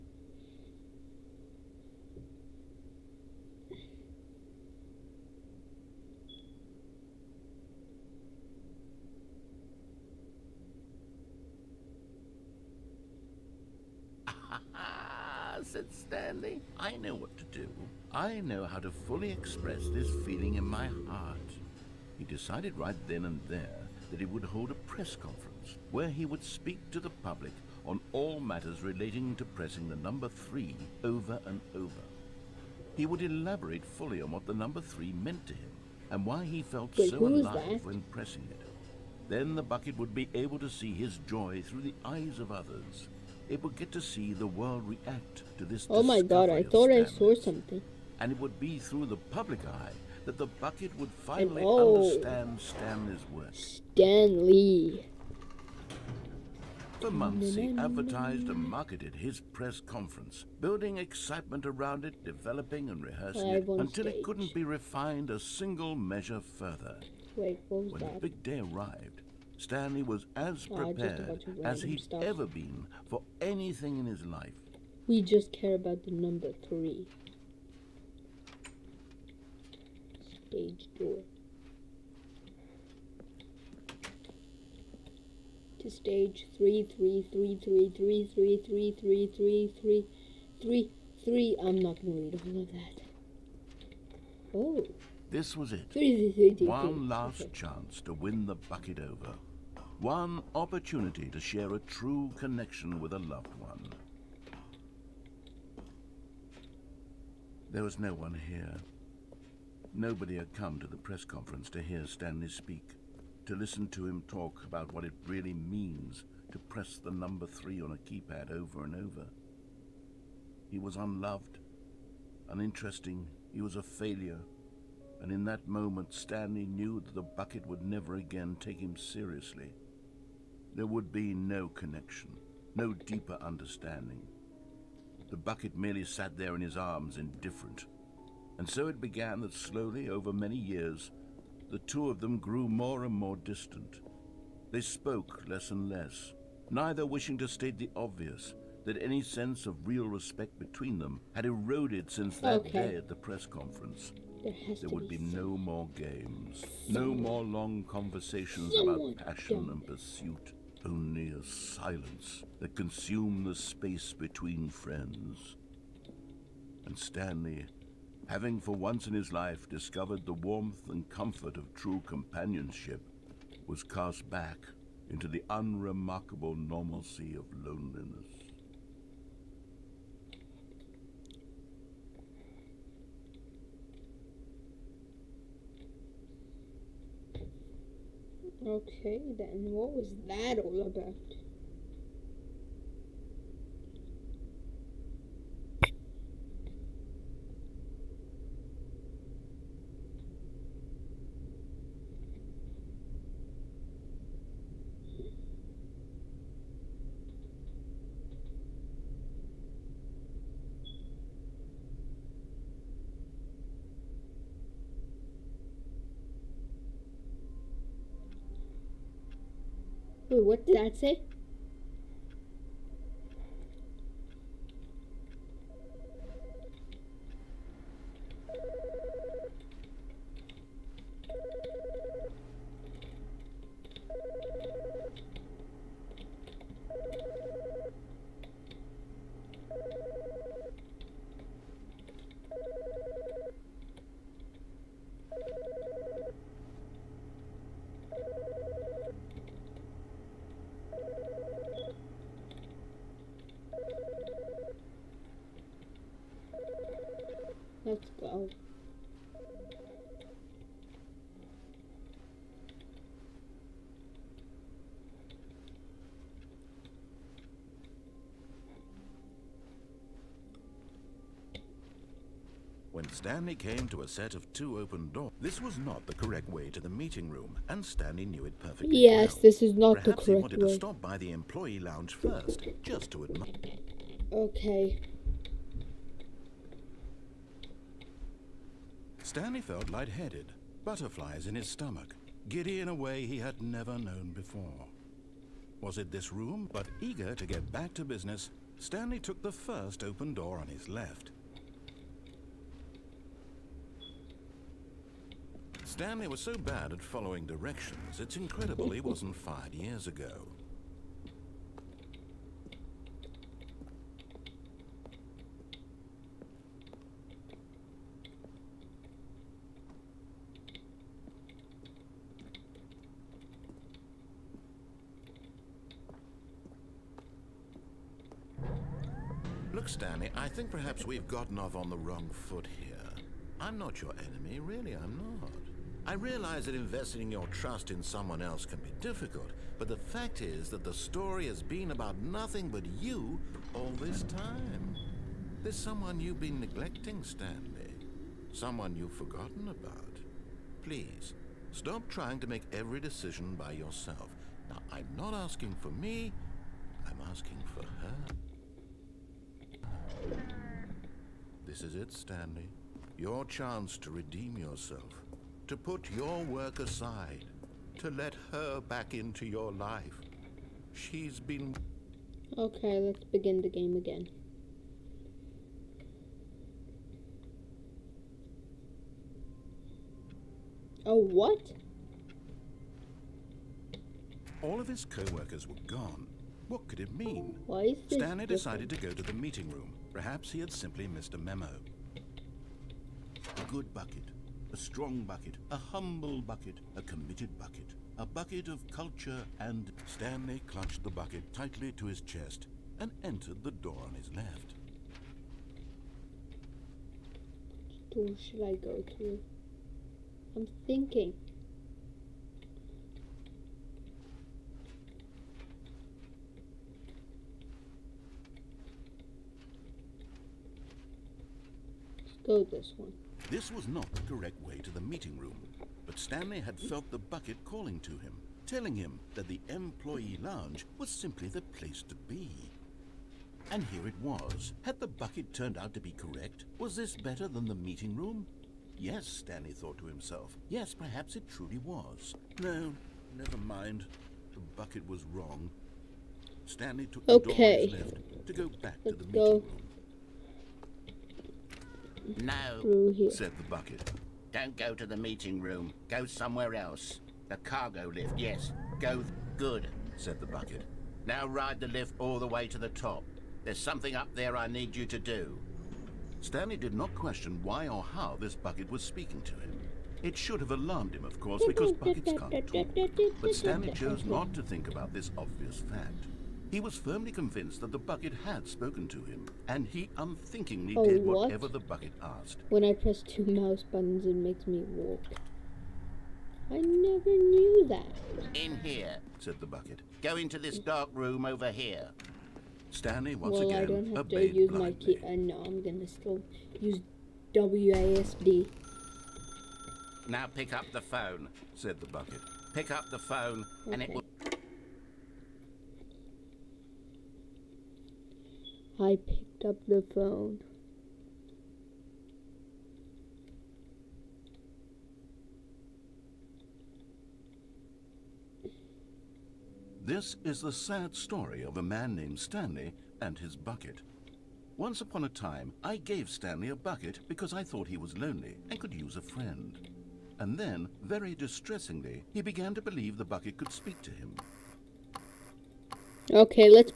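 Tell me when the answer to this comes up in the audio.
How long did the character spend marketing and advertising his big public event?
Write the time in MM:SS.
00:57.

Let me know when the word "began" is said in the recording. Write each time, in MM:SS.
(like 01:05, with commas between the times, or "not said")
02:19, 08:52.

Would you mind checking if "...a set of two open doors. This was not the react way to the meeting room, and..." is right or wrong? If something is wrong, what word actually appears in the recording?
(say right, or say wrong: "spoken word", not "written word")
wrong: "correct", not "react".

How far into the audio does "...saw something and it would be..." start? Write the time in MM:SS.
00:47.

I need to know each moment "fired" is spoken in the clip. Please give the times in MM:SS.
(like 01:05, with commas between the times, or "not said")
05:09.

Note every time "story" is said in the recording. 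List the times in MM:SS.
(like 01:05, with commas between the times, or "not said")
05:40, 08:41.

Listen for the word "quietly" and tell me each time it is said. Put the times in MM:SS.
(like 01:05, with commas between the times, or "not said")
not said.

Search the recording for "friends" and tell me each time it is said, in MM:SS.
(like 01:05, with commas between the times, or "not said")
02:44, 08:49.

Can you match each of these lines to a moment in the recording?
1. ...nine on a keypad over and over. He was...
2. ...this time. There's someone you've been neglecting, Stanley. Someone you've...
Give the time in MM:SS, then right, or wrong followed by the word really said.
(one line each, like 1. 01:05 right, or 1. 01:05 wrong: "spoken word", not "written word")
1. 01:57 wrong: "three", not "nine"
2. 05:44 right.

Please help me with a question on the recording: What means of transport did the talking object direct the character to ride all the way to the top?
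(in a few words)
Cargo lift.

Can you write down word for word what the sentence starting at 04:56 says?
But eager to get back to business, Stanley took the first open door on his left.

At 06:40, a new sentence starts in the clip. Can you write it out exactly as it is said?
Stanley clutched the bucket tightly to his chest and entered the door on his left.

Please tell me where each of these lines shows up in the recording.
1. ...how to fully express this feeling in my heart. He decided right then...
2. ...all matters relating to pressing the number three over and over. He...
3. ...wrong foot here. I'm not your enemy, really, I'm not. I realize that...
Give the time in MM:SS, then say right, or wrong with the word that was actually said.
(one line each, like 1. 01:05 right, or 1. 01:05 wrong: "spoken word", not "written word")
1. 00:18 right
2. 00:28 right
3. 05:31 right.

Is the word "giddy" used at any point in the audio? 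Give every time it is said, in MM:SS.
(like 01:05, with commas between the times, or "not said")
04:52.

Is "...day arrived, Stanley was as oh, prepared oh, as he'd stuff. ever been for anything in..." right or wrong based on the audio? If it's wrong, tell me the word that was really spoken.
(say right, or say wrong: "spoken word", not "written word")
right.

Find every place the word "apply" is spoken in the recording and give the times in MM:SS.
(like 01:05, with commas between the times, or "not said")
not said.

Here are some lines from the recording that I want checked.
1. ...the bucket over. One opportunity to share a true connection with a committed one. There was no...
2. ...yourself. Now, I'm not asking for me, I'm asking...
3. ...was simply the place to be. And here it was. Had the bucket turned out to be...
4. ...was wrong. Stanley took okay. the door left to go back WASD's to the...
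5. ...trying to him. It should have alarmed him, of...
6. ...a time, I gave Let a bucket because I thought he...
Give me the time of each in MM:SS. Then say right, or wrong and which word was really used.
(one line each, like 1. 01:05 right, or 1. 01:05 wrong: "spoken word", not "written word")
1. 01:38 wrong: "loved", not "committed"
2. 05:53 right
3. 07:10 right
4. 07:25 wrong: "Let", not "WASD"
5. 07:49 wrong: "speaking", not "trying"
6. 08:45 wrong: "Stanley", not "Let".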